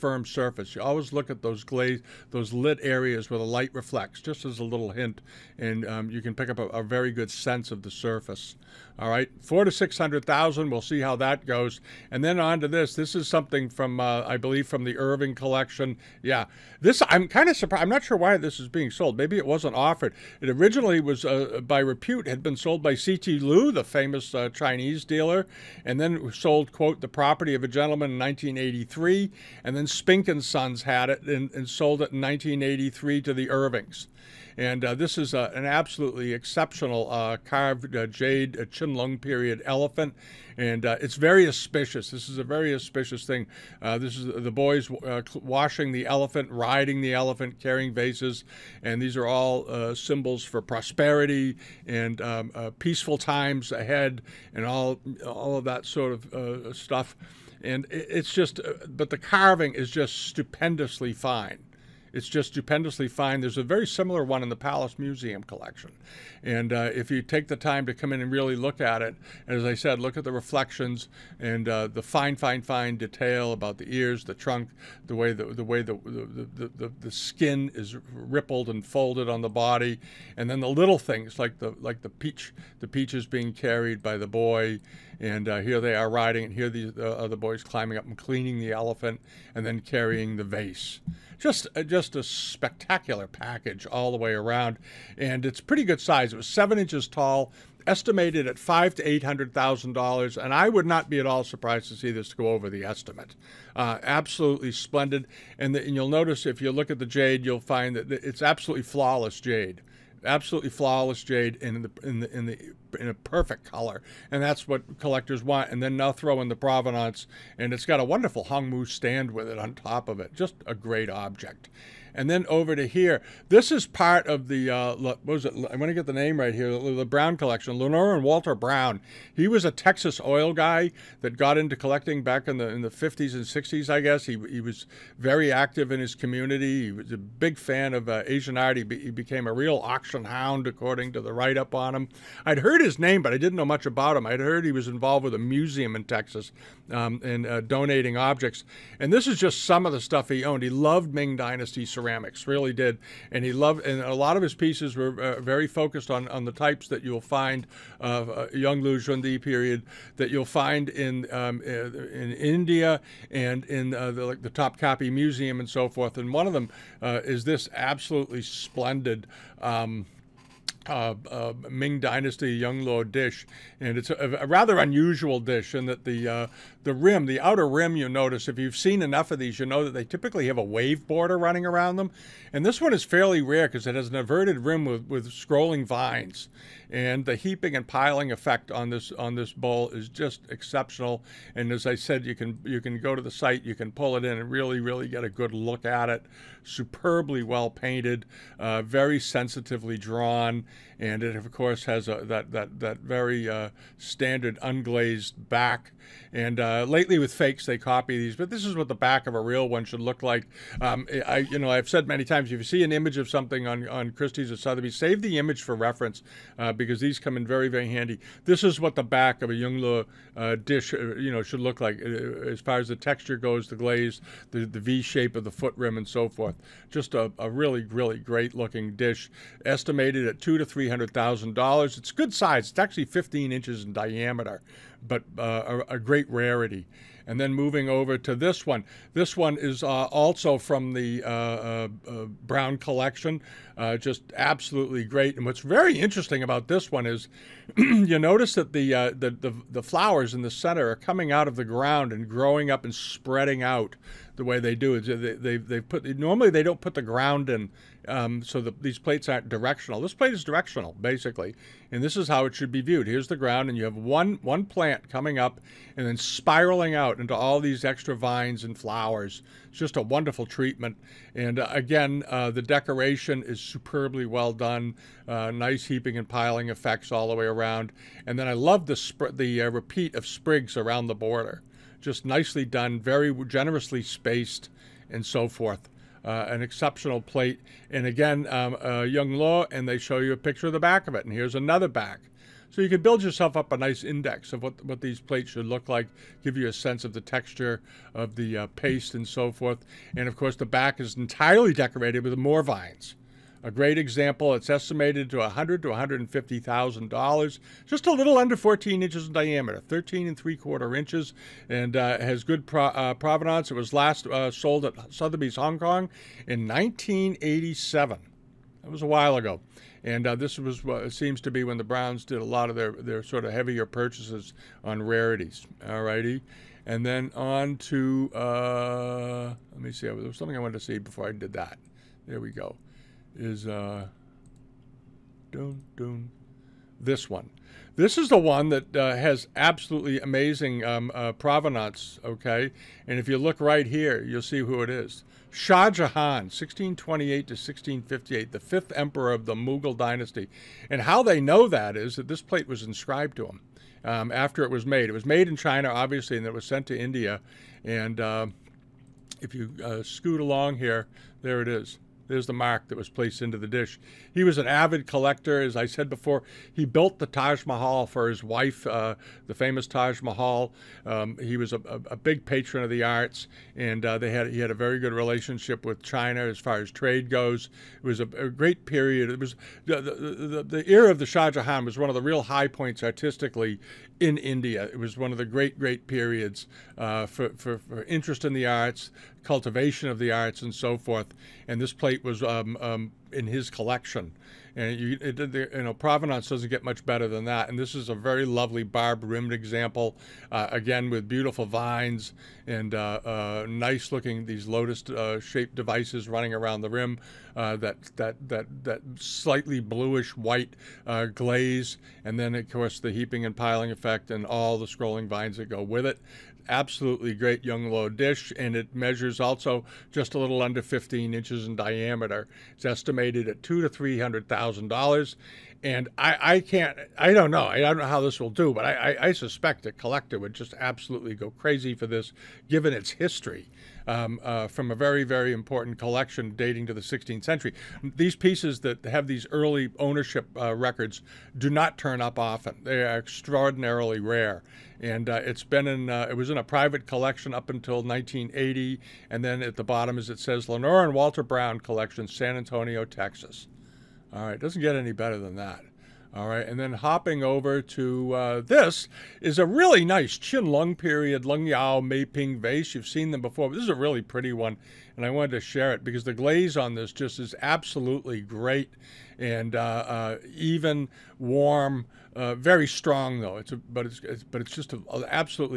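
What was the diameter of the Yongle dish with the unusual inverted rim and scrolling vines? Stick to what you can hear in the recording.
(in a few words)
15 inches.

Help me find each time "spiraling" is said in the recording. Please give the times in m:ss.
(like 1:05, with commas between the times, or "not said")
4:26.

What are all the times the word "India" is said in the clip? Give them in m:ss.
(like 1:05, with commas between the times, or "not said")
2:42, 5:56, 6:24.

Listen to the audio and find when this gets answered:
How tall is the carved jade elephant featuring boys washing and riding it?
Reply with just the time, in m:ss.
1:36.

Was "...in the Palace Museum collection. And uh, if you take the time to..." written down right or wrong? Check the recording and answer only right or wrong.
right.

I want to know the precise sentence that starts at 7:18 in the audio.
These pieces that have these early ownership uh, records do not turn up often.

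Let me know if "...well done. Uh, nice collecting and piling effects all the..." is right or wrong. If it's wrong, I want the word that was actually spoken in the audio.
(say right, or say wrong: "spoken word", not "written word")
wrong: "heaping", not "collecting".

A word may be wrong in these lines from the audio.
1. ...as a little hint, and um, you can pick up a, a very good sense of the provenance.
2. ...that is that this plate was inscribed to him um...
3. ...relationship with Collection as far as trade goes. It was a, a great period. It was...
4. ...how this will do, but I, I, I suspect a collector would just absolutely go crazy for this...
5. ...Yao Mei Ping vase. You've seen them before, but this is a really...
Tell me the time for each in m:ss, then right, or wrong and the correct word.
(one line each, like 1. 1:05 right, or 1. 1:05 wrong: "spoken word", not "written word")
1. 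0:04 wrong: "surface", not "provenance"
2. 5:51 right
3. 6:15 wrong: "China", not "Collection"
4. 7:08 right
5. 7:41 right.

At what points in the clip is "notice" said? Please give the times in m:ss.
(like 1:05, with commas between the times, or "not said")
1:46, 2:58, 4:08.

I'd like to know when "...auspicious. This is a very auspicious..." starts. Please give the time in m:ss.
0:41.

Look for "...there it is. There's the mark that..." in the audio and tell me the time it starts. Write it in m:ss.
6:01.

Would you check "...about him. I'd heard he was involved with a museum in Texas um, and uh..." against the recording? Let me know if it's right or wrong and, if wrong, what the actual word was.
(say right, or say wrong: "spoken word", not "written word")
right.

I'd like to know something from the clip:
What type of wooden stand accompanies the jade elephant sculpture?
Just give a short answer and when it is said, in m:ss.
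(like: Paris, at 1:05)
hongmu, at 1:58.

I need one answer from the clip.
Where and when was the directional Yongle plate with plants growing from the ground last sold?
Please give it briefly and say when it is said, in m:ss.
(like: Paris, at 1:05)
Sotheby's Hong Kong, 1987, at 5:15.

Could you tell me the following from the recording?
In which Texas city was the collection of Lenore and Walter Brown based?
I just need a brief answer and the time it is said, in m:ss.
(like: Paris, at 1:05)
San Antonio, at 7:32.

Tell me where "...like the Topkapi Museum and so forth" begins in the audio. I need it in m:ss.
2:44.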